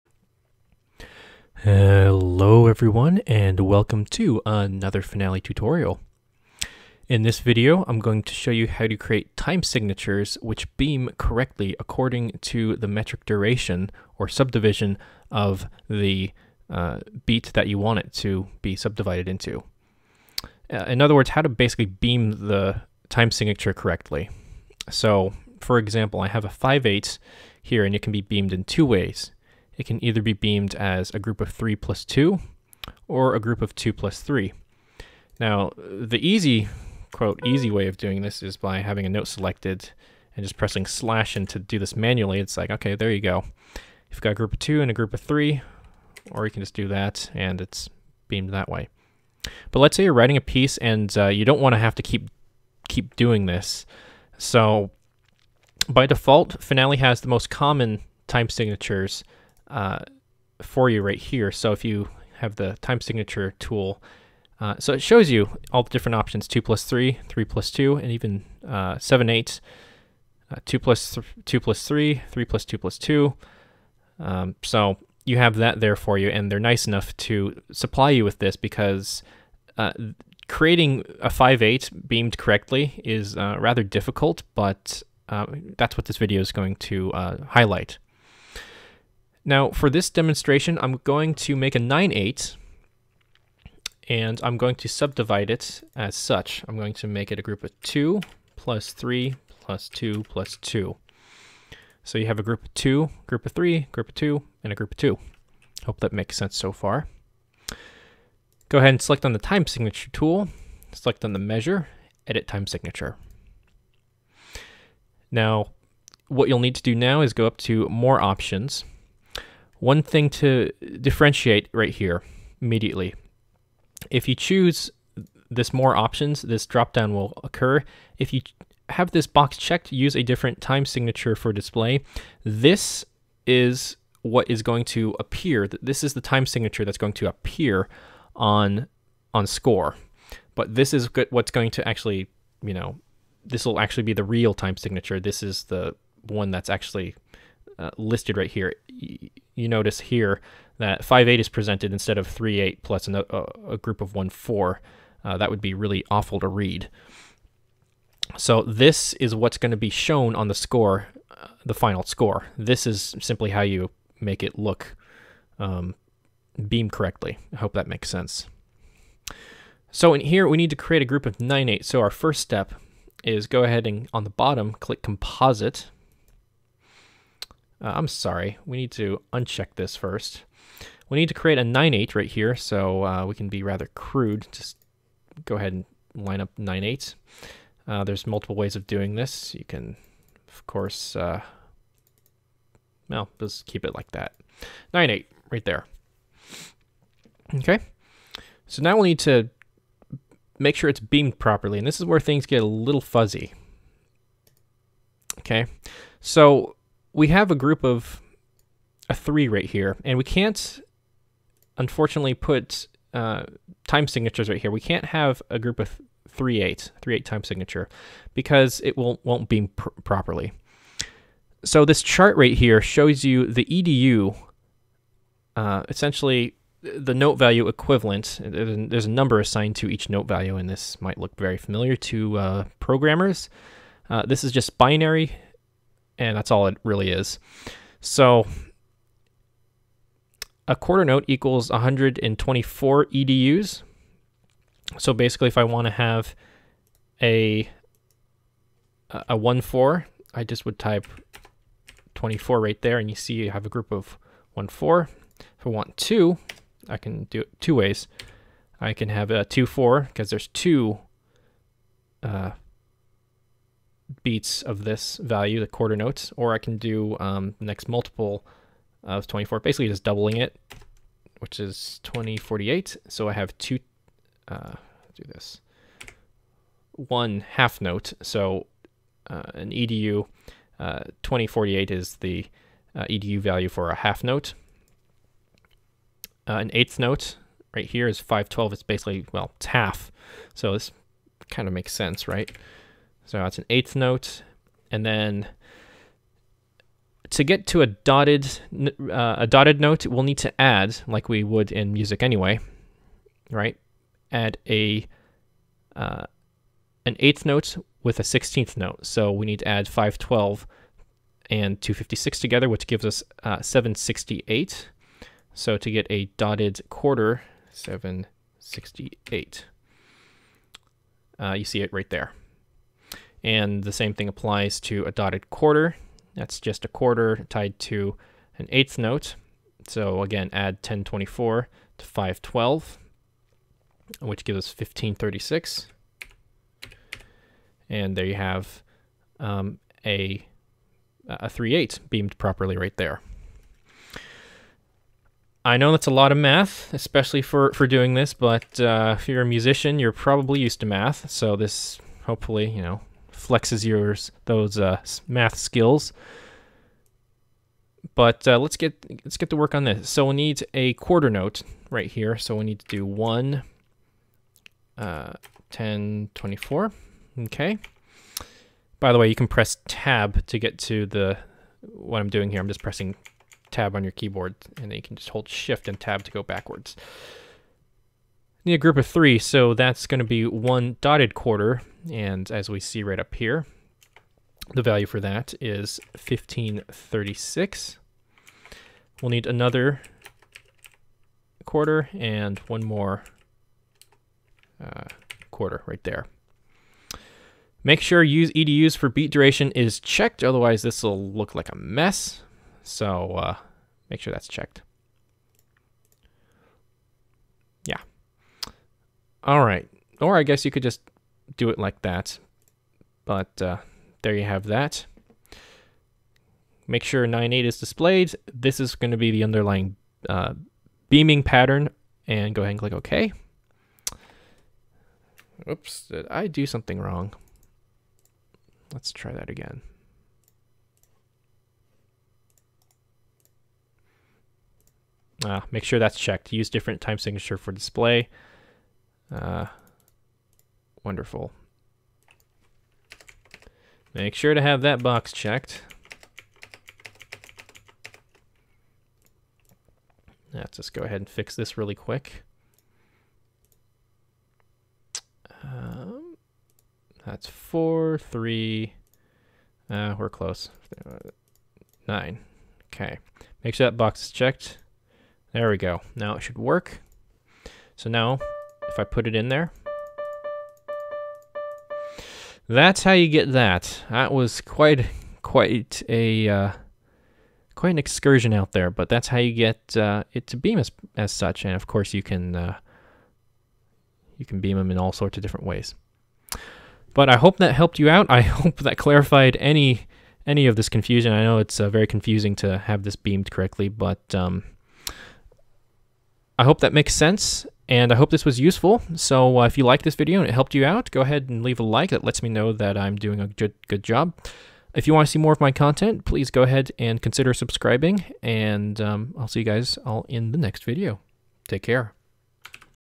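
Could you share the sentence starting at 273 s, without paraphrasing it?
So I have two, uh, do this, one half note.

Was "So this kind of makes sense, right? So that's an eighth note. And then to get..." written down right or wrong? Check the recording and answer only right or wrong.
right.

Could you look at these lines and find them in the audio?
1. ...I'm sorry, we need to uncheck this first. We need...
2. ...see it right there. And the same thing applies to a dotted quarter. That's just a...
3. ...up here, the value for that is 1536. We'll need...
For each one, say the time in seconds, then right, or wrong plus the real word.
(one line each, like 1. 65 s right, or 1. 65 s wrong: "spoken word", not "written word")
1. 177 s right
2. 321 s right
3. 383 s right.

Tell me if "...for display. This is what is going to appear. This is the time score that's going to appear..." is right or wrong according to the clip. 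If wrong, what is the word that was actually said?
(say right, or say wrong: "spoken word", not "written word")
wrong: "signature", not "score".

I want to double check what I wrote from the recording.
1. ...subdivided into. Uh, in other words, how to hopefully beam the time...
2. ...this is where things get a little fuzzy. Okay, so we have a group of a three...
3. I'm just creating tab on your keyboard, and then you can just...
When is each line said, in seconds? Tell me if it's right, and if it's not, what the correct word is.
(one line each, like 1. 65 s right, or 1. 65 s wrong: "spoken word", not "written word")
1. 18 s wrong: "basically", not "hopefully"
2. 201 s right
3. 372 s wrong: "pressing", not "creating".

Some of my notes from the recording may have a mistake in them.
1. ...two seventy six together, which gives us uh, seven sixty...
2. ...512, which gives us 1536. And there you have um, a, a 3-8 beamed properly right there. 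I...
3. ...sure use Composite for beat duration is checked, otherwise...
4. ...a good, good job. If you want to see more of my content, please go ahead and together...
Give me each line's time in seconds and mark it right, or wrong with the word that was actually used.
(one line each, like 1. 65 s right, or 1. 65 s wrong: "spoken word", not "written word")
1. 311 s wrong: "fifty", not "seventy"
2. 332 s right
3. 398 s wrong: "EDUs", not "Composite"
4. 503 s wrong: "consider", not "together".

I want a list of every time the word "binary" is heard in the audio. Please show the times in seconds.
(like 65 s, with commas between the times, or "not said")
234 s.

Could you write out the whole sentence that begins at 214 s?
We can't have a group of three eight, three eight time signature, because it will won't beam pr properly.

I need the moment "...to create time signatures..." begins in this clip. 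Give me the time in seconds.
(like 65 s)
8 s.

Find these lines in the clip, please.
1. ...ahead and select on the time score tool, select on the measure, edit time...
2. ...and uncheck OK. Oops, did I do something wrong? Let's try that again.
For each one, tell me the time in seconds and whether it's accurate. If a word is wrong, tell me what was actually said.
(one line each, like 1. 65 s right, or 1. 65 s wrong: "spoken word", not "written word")
1. 108 s wrong: "signature", not "score"
2. 422 s wrong: "click", not "uncheck".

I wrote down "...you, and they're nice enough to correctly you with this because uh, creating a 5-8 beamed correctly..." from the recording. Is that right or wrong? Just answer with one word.
wrong.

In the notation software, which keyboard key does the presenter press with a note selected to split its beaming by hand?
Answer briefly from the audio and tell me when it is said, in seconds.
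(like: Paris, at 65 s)
slash, at 40 s.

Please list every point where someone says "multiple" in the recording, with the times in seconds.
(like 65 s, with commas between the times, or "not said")
188 s, 267 s.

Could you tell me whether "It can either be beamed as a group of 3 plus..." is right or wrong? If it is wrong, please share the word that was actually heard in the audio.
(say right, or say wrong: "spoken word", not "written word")
right.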